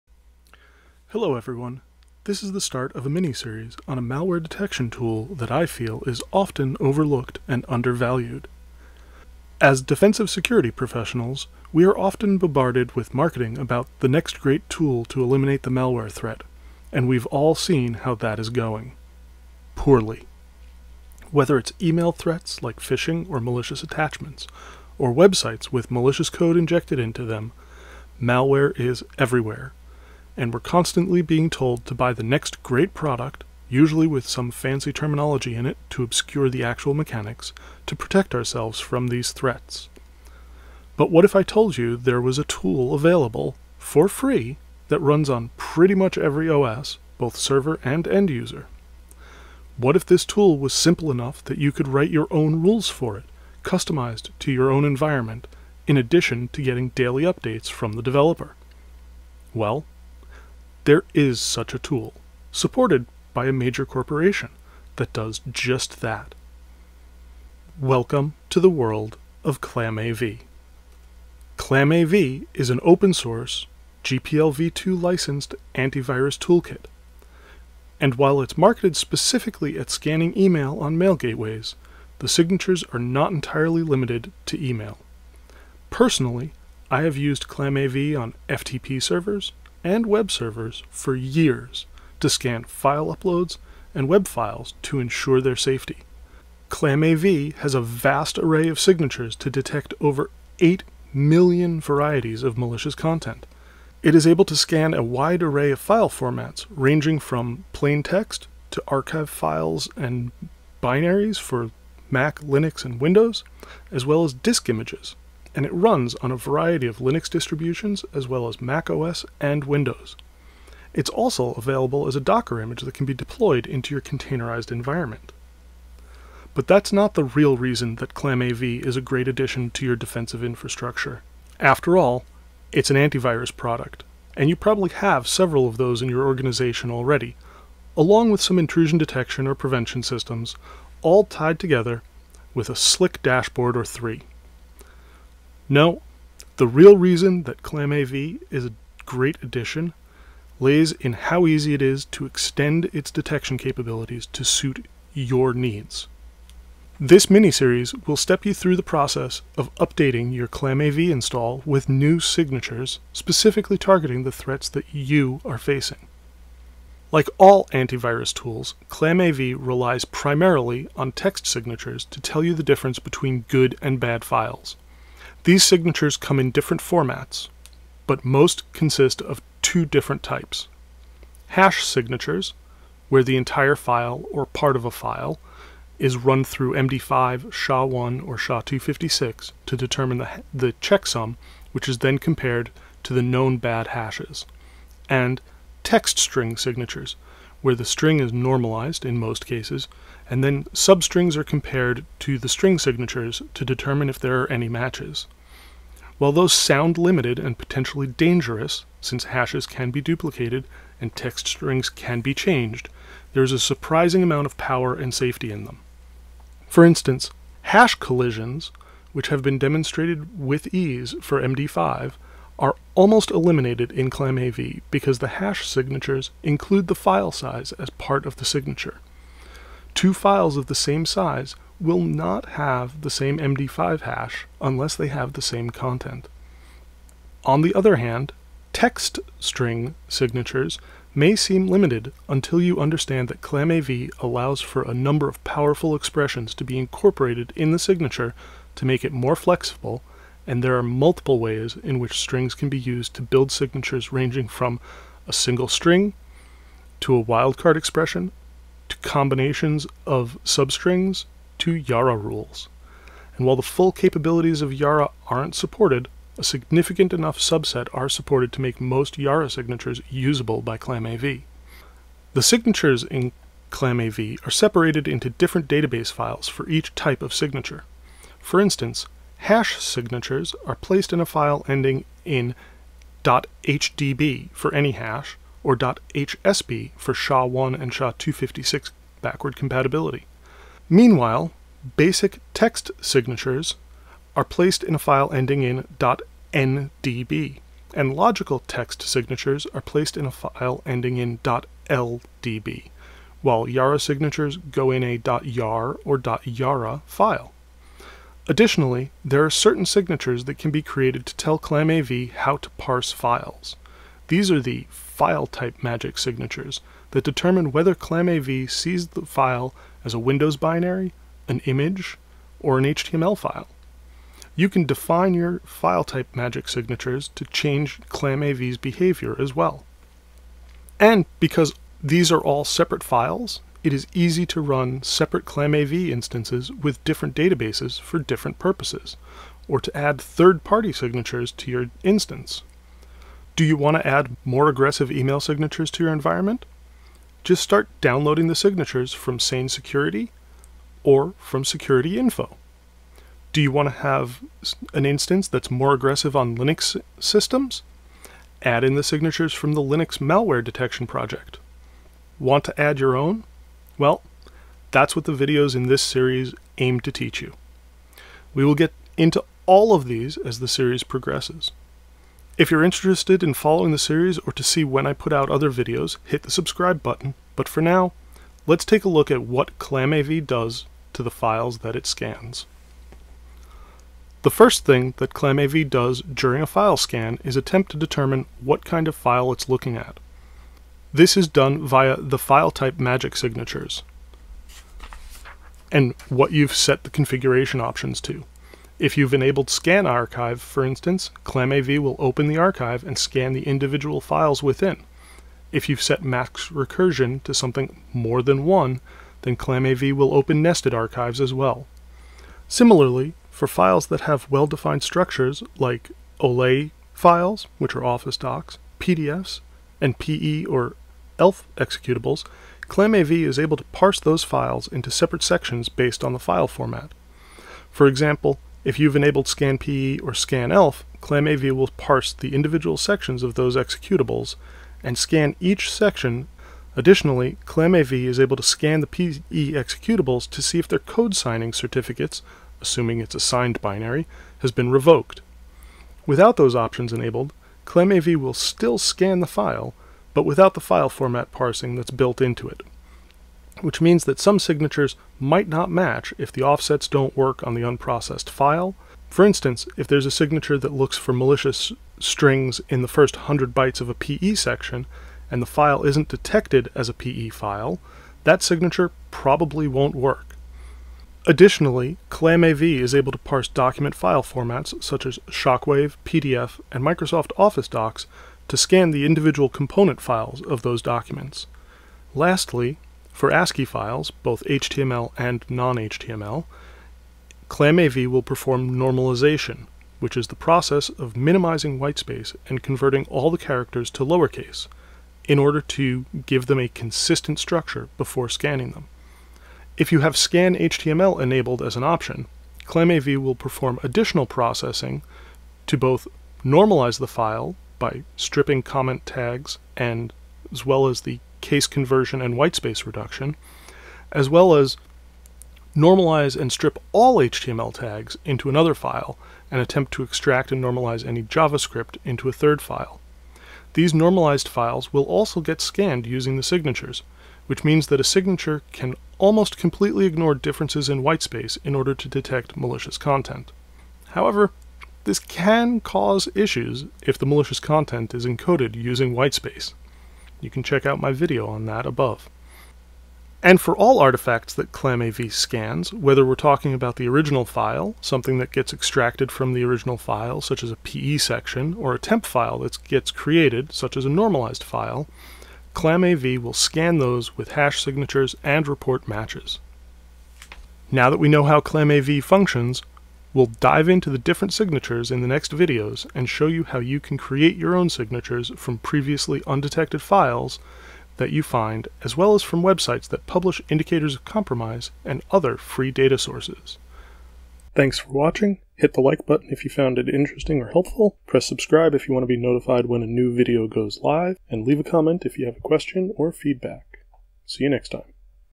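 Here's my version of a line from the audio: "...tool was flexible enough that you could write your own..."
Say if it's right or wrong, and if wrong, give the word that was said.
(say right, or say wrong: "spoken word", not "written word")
wrong: "simple", not "flexible".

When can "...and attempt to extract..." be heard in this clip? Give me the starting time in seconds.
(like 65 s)
519 s.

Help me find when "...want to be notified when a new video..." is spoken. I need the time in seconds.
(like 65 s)
582 s.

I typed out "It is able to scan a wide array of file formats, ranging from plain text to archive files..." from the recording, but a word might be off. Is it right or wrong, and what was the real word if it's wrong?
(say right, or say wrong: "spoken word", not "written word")
right.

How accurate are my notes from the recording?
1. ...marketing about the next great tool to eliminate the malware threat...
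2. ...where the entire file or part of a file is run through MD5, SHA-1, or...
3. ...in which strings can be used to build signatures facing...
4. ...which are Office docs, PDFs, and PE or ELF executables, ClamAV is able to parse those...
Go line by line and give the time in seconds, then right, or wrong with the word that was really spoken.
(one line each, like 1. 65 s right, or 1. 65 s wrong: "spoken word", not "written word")
1. 13 s right
2. 183 s right
3. 251 s wrong: "ranging", not "facing"
4. 417 s right.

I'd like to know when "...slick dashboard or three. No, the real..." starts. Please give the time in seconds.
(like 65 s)
142 s.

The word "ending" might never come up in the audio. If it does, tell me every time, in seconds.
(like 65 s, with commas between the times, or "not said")
281 s, 295 s, 300 s.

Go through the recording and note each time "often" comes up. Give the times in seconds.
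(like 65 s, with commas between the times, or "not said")
6 s, 11 s.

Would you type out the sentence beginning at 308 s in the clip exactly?
Additionally, there are certain signatures that can be created to tell ClamAV how to parse files.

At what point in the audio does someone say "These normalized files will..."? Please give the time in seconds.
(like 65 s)
523 s.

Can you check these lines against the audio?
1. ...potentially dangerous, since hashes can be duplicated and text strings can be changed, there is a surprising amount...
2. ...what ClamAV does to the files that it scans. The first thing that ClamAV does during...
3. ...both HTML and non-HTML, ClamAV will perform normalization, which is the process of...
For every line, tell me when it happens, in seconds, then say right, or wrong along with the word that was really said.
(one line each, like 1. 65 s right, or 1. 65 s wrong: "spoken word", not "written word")
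1. 207 s right
2. 379 s right
3. 484 s right.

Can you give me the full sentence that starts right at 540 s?
You can check out my video on that above.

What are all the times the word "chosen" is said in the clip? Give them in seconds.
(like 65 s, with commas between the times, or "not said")
not said.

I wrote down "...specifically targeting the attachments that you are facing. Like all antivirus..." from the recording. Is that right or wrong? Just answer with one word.
wrong.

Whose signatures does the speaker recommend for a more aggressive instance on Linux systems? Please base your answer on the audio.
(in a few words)
Linux Malware Detection Project.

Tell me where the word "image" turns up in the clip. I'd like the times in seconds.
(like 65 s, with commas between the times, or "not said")
114 s, 122 s, 321 s.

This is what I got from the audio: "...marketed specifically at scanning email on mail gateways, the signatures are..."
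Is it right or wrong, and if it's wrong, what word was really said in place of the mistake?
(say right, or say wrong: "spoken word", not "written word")
right.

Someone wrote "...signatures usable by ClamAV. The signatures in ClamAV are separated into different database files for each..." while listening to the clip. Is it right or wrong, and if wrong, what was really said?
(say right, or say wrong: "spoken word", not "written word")
right.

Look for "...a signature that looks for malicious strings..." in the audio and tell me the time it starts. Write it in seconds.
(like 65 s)
460 s.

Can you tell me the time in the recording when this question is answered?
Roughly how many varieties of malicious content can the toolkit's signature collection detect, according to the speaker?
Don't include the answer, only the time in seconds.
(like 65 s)
100 s.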